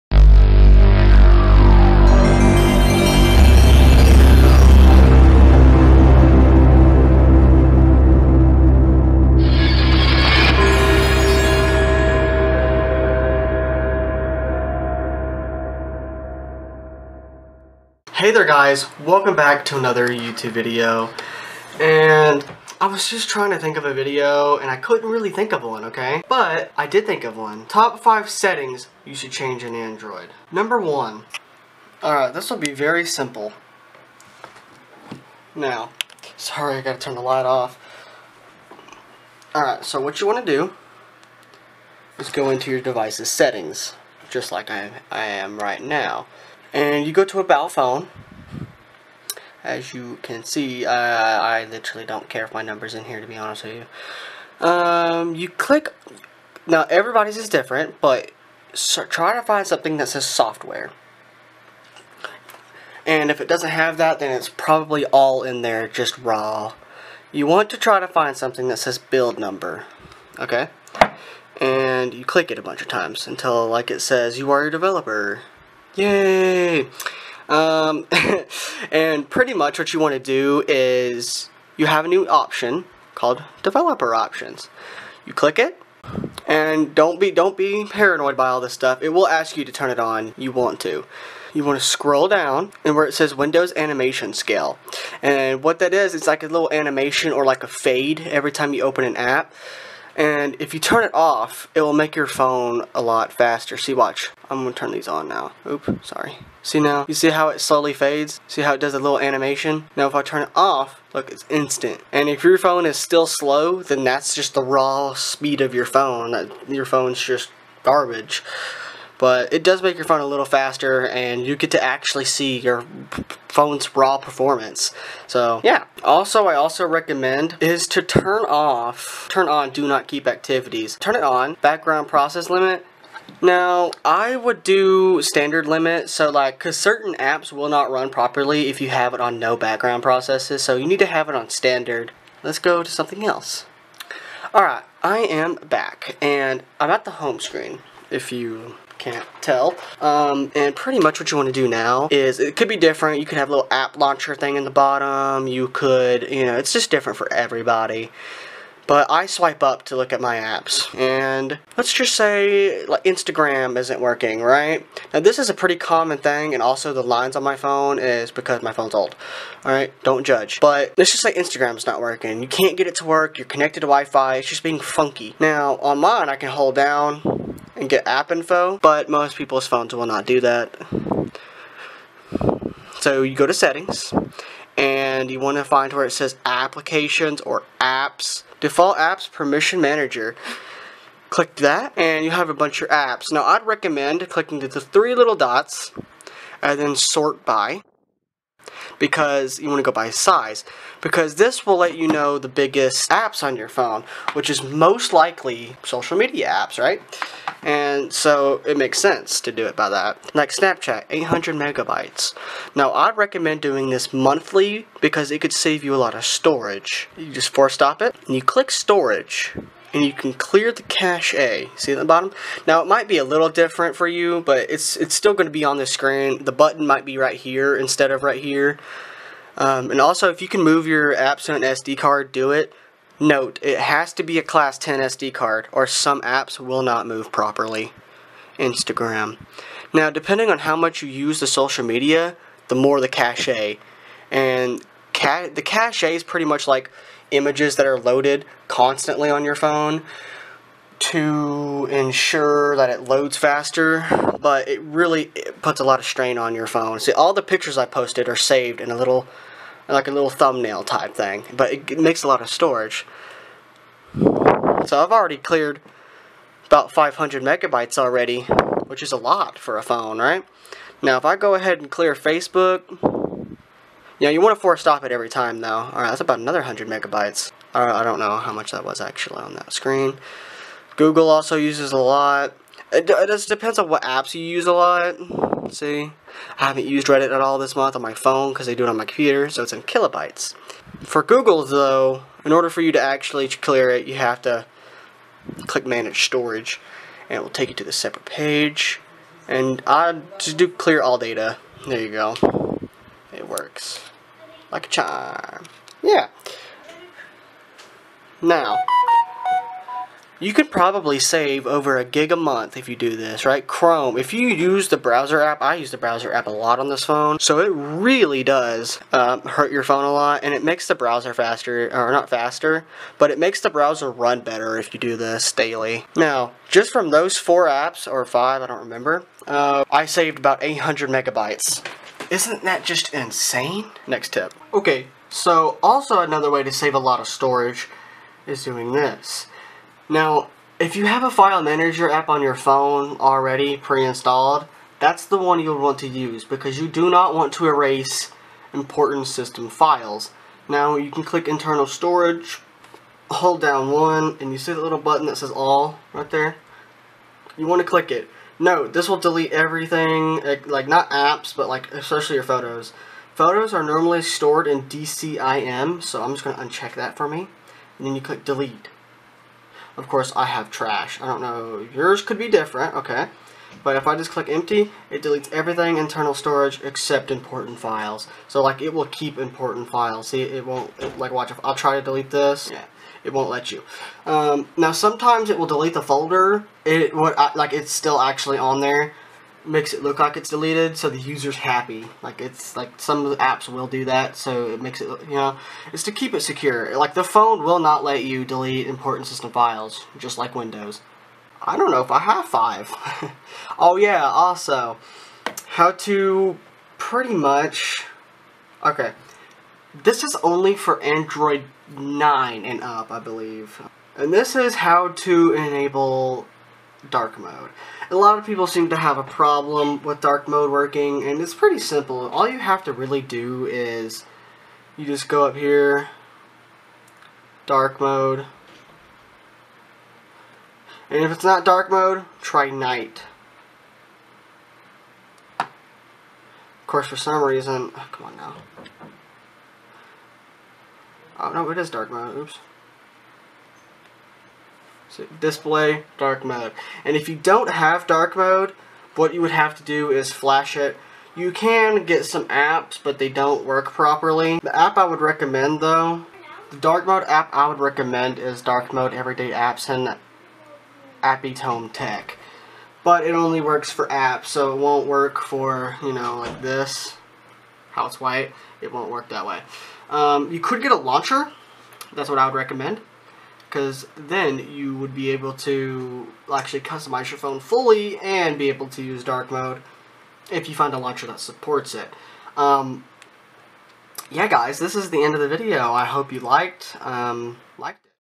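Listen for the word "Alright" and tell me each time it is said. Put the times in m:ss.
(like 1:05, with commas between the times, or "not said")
0:32, 0:39, 2:24, 4:35.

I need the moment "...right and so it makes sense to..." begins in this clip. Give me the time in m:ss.
3:26.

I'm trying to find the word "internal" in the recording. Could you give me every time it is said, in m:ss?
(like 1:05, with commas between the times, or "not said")
5:51, 6:15.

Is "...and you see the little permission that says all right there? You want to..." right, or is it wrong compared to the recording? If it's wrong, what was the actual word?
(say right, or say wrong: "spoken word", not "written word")
wrong: "button", not "permission".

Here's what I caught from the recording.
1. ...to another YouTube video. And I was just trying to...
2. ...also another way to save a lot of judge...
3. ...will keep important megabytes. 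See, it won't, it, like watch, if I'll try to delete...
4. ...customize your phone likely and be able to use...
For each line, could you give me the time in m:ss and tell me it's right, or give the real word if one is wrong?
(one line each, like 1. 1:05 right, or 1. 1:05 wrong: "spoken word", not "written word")
1. 0:19 right
2. 5:35 wrong: "storage", not "judge"
3. 6:18 wrong: "files", not "megabytes"
4. 7:56 wrong: "fully", not "likely".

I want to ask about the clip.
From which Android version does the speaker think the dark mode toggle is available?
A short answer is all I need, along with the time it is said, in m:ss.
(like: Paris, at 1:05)
Android 9, at 6:51.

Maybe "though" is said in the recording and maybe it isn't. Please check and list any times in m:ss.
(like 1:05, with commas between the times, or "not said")
4:35, 4:51, 7:35.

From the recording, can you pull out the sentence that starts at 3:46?
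The button might be right here instead of right here.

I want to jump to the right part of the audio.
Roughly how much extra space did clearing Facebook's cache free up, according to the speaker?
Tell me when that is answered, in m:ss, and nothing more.
4:36.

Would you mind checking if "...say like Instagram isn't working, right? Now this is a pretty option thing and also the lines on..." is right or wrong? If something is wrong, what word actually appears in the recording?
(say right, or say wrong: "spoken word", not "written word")
wrong: "common", not "option".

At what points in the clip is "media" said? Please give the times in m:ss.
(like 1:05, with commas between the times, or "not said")
3:26, 4:01.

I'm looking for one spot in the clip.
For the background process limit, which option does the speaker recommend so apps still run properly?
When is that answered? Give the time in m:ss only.
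2:15.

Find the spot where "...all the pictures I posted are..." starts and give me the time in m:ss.
4:17.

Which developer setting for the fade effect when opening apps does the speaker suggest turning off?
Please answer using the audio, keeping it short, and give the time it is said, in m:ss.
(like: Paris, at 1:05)
Windows animation scale, at 1:33.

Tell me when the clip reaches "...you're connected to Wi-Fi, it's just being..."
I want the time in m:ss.
2:53.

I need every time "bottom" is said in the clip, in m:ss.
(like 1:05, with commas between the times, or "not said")
2:34, 3:42.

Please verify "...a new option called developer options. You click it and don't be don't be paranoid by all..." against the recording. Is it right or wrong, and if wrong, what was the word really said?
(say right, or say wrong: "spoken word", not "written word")
right.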